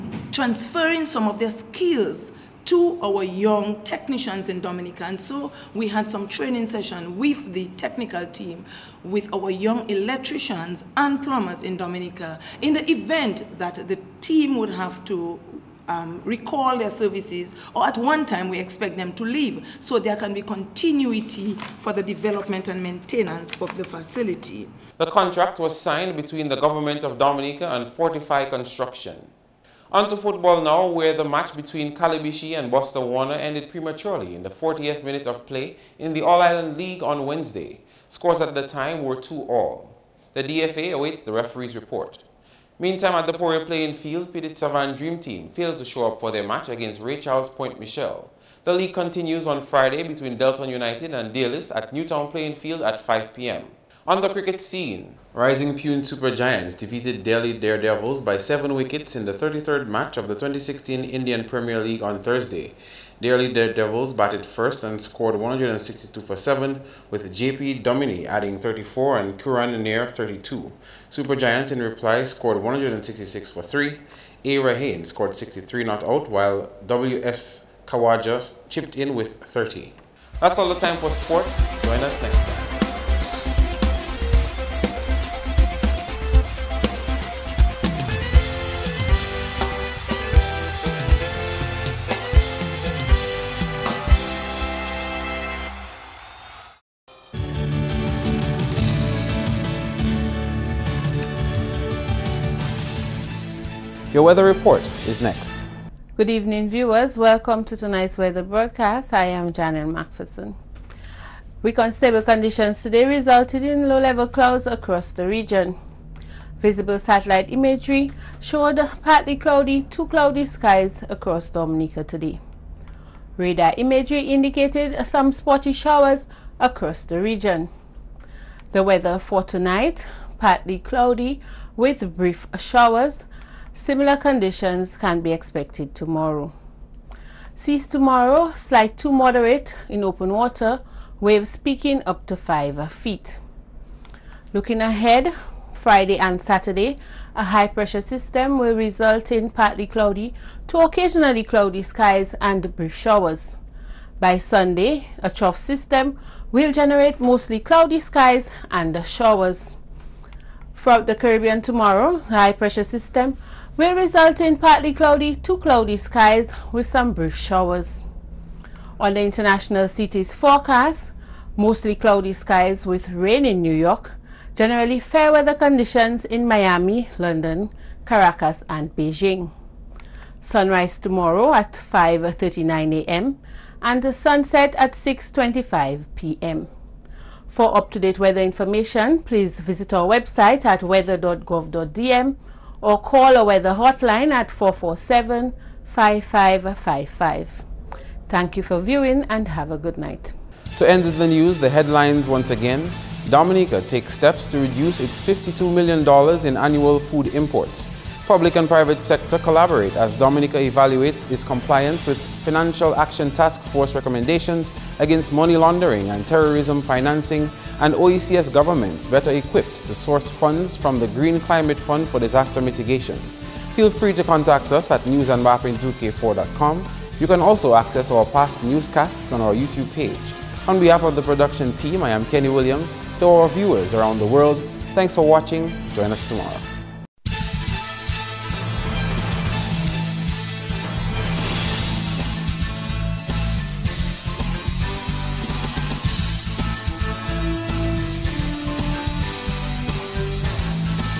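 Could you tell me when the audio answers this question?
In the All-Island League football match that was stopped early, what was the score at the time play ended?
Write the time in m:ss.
0:39.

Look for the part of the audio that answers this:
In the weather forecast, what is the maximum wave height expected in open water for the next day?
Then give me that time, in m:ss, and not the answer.
2:22.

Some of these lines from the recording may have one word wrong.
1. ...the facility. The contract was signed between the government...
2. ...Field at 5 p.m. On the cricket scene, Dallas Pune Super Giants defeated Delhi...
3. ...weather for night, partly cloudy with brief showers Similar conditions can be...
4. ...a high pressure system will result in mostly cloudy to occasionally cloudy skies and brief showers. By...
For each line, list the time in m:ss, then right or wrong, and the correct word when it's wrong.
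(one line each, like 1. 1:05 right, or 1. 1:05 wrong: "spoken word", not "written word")
1. 0:23 right
2. 0:52 wrong: "Rising", not "Dallas"
3. 2:08 wrong: "tonight", not "night"
4. 2:27 wrong: "partly", not "mostly".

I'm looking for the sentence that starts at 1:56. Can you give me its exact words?
Visible satellite imagery showed partly cloudy to cloudy skies across Dominica today.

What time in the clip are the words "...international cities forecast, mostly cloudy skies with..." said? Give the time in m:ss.
2:49.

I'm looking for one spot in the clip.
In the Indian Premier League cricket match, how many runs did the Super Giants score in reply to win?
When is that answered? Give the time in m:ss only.
1:12.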